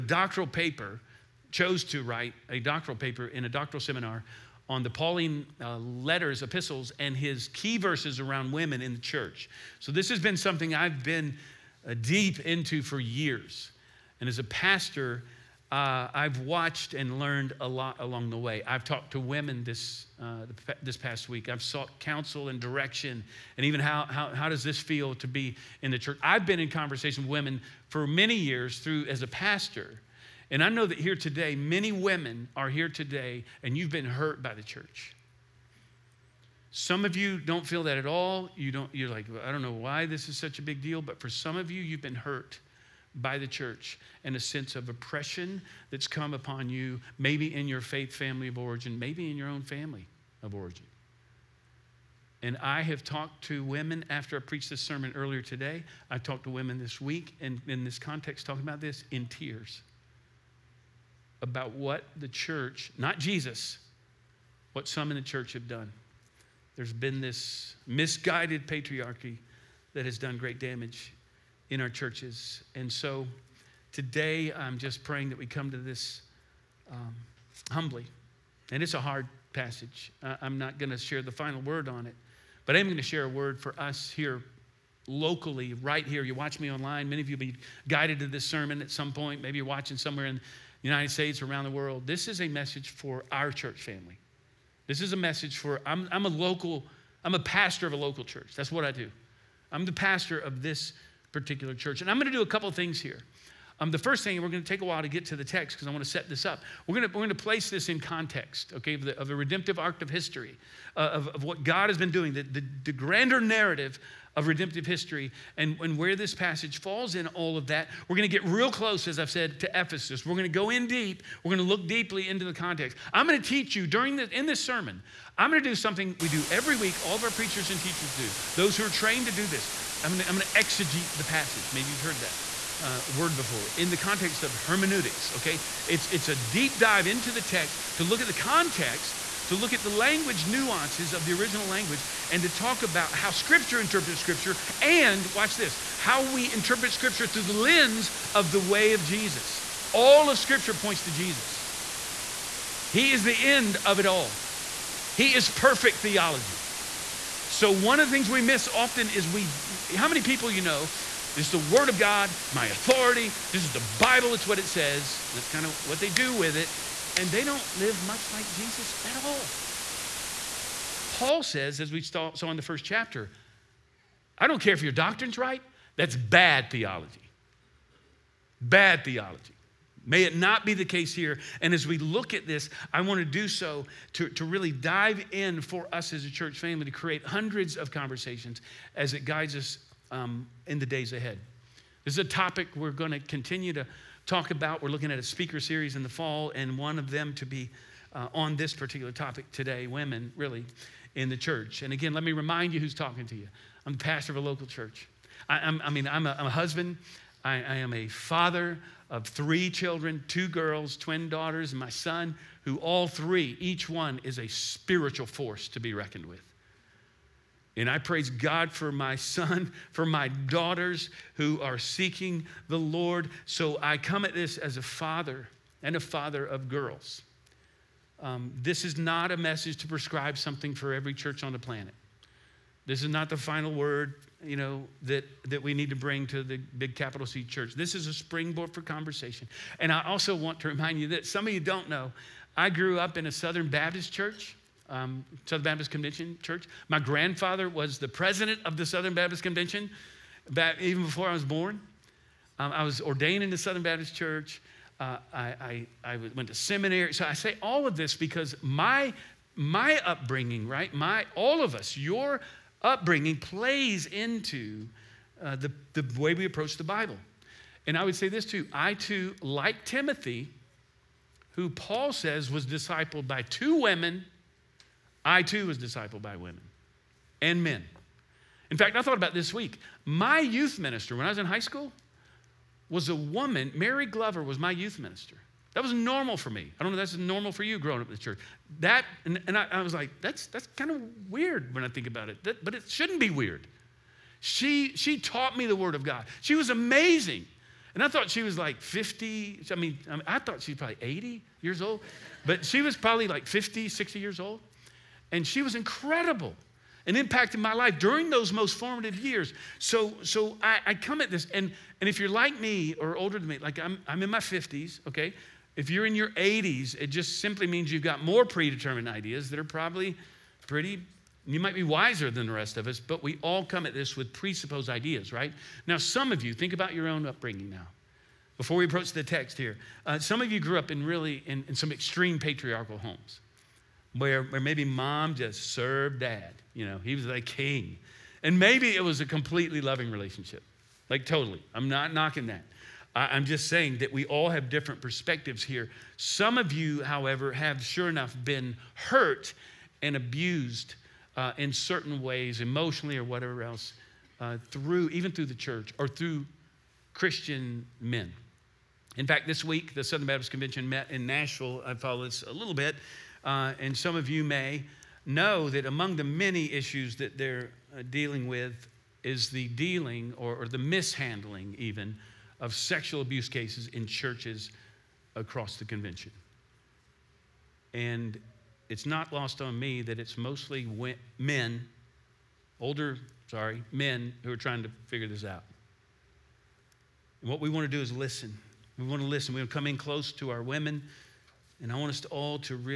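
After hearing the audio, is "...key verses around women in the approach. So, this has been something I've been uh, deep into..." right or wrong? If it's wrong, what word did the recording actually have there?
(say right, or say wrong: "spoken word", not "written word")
wrong: "church", not "approach".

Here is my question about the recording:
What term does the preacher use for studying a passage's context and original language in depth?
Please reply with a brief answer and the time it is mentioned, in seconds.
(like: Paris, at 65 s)
Exegete, at 130 s.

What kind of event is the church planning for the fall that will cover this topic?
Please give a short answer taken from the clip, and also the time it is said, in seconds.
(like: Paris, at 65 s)
Speaker series, at 195 s.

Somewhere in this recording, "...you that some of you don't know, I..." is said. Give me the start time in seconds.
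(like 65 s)
240 s.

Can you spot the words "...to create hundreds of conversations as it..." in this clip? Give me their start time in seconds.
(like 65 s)
186 s.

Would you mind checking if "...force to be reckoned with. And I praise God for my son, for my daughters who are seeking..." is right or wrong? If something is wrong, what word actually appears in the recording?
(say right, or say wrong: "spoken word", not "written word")
right.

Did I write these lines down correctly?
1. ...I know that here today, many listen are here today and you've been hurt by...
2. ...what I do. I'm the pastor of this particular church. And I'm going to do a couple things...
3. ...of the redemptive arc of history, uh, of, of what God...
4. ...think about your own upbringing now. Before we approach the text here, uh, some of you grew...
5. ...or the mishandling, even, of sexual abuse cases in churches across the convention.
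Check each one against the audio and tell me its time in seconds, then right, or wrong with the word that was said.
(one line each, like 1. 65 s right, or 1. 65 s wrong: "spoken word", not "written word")
1. 30 s wrong: "women", not "listen"
2. 98 s right
3. 109 s right
4. 326 s right
5. 370 s right.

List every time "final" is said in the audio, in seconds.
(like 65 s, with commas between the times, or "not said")
81 s, 233 s.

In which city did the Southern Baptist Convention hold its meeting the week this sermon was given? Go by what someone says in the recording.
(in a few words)
Nashville.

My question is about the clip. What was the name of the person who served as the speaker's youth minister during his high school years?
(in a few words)
Mary Glover.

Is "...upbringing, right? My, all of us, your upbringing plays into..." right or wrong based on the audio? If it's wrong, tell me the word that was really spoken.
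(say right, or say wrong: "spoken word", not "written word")
right.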